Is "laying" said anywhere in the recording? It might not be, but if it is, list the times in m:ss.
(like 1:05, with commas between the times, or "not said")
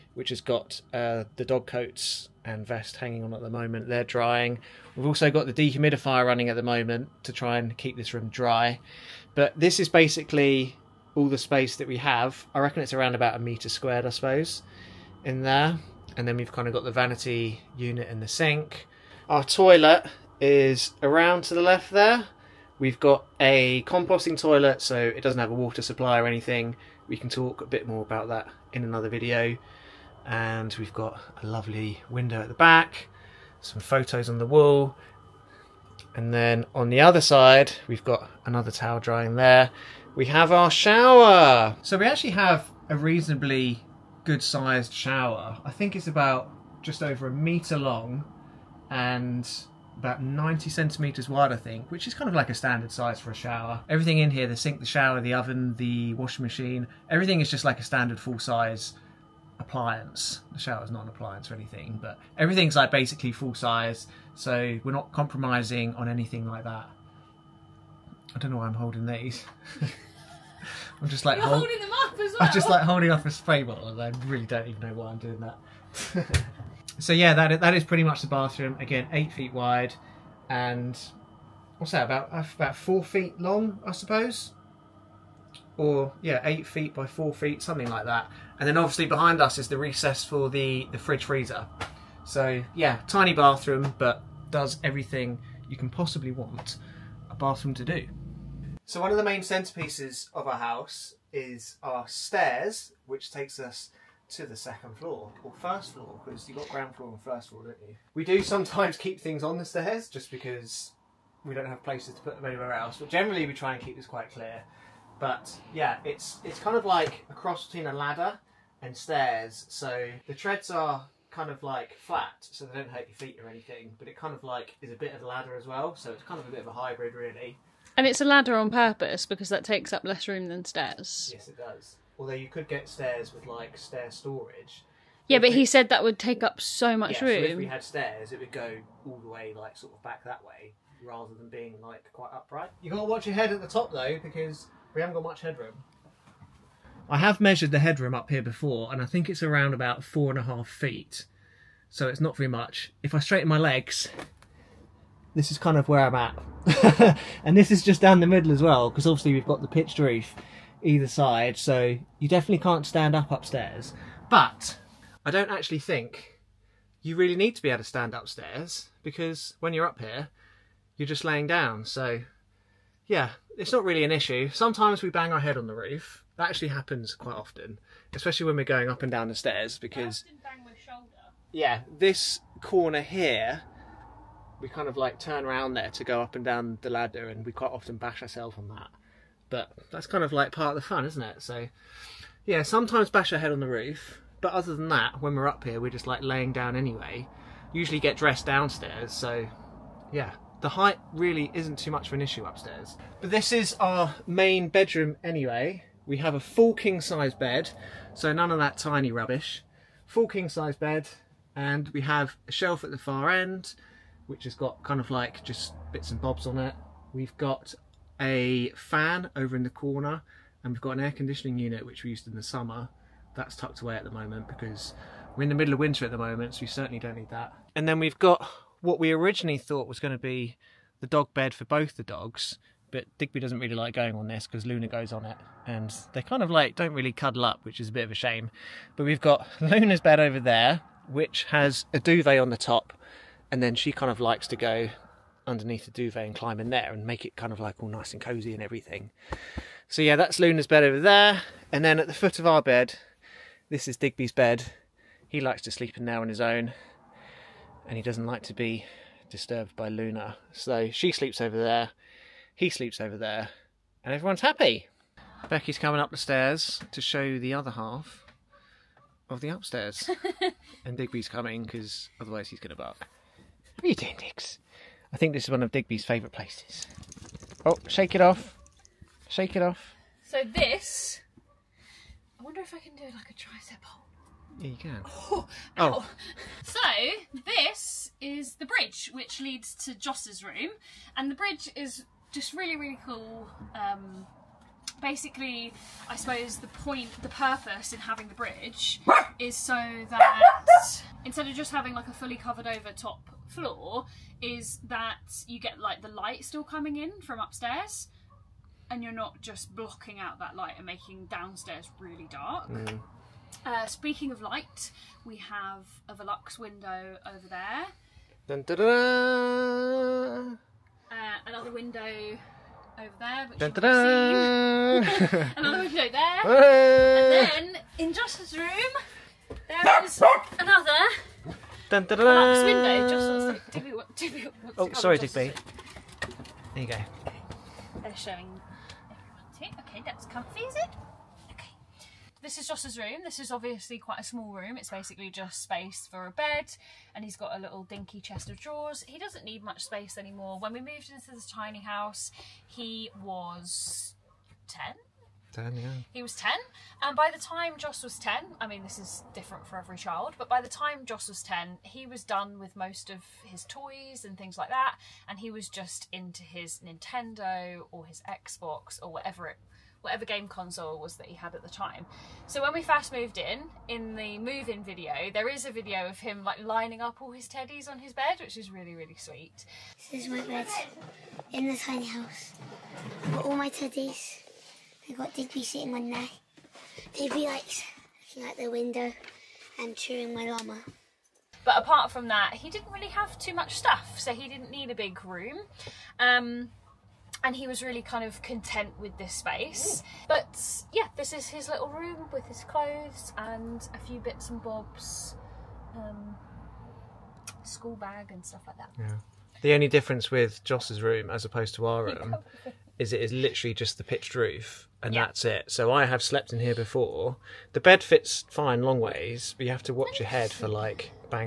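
2:51, 3:16.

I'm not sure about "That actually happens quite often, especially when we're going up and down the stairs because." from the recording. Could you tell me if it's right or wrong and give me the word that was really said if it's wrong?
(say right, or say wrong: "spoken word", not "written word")
right.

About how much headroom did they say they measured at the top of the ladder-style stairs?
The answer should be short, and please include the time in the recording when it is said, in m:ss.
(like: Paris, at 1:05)
4.5 feet, at 2:30.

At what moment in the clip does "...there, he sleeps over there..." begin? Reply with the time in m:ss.
4:21.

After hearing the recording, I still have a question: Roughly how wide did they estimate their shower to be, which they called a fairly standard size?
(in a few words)
90 centimeters.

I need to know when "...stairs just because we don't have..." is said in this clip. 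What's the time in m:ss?
1:49.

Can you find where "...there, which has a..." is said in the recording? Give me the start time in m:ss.
4:00.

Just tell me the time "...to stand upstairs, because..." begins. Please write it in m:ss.
2:47.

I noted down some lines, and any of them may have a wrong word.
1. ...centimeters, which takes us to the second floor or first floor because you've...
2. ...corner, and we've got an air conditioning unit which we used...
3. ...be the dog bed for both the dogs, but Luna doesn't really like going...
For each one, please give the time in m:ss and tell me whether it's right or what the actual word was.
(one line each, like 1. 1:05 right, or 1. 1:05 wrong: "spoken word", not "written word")
1. 1:42 wrong: "stairs", not "centimeters"
2. 3:39 right
3. 3:50 wrong: "Digby", not "Luna".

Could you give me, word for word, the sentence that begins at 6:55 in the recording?
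So I have slept in here before.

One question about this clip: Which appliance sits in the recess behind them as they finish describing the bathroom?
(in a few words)
fridge freezer.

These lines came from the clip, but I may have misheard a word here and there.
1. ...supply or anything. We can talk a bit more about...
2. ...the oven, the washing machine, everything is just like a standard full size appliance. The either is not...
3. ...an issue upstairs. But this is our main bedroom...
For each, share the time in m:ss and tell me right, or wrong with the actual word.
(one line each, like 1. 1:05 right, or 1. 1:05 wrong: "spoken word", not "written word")
1. 0:25 right
2. 0:55 wrong: "shower", not "either"
3. 3:22 right.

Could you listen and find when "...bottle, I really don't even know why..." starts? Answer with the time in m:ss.
1:13.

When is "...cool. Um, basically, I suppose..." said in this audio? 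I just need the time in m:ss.
4:53.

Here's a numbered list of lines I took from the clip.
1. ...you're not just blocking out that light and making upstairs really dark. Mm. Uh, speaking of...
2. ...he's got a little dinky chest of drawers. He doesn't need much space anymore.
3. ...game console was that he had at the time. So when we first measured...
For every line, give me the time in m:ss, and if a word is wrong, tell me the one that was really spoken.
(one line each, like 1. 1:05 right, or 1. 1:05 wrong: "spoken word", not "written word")
1. 5:09 wrong: "downstairs", not "upstairs"
2. 5:47 right
3. 6:10 wrong: "moved", not "measured".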